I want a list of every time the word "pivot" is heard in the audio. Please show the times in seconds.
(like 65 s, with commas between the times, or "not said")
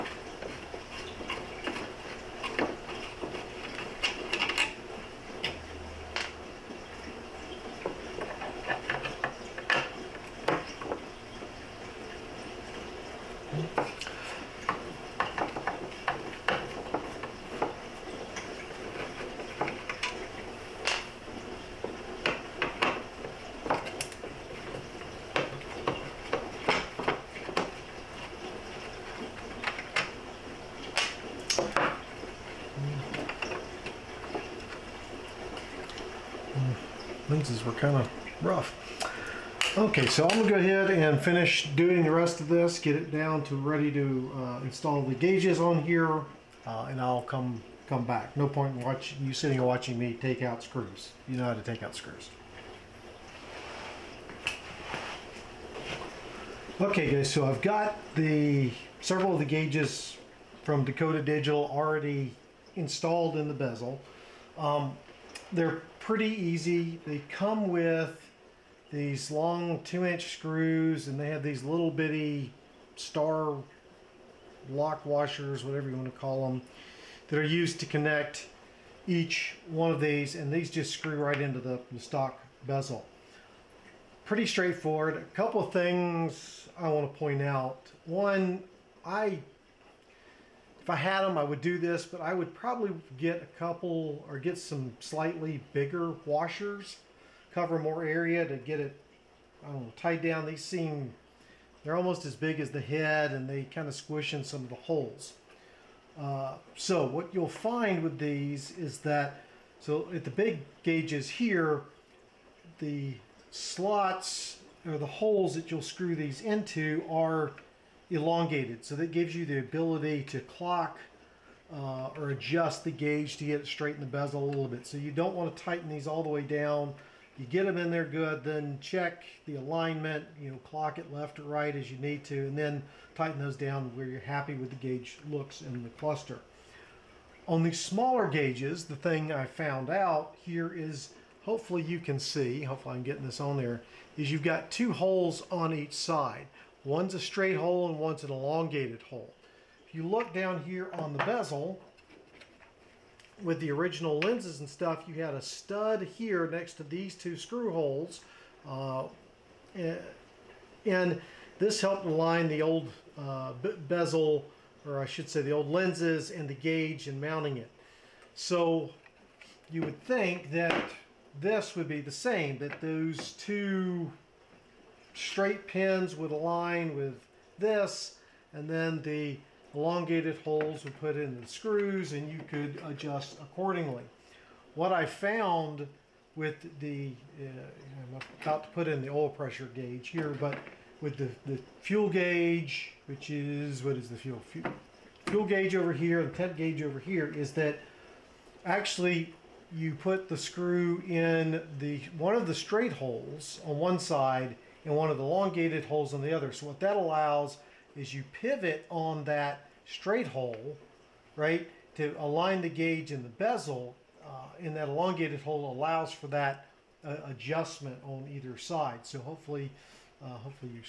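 208 s.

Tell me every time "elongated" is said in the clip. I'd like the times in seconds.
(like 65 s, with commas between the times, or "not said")
118 s, 148 s, 179 s, 205 s, 214 s.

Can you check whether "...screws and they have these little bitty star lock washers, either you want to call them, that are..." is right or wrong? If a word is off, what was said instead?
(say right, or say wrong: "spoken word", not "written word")
wrong: "whatever", not "either".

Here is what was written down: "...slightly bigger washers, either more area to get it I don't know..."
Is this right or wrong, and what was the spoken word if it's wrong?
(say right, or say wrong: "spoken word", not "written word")
wrong: "cover", not "either".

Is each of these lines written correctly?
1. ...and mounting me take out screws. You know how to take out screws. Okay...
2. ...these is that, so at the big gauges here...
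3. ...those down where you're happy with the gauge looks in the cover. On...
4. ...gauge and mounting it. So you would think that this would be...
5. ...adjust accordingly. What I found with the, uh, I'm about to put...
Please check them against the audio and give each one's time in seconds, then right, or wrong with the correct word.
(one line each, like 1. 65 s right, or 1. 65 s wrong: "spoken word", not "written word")
1. 49 s wrong: "watching", not "mounting"
2. 108 s right
3. 133 s wrong: "cluster", not "cover"
4. 166 s right
5. 182 s right.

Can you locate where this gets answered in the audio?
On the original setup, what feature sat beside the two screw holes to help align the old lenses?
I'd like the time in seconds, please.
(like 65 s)
155 s.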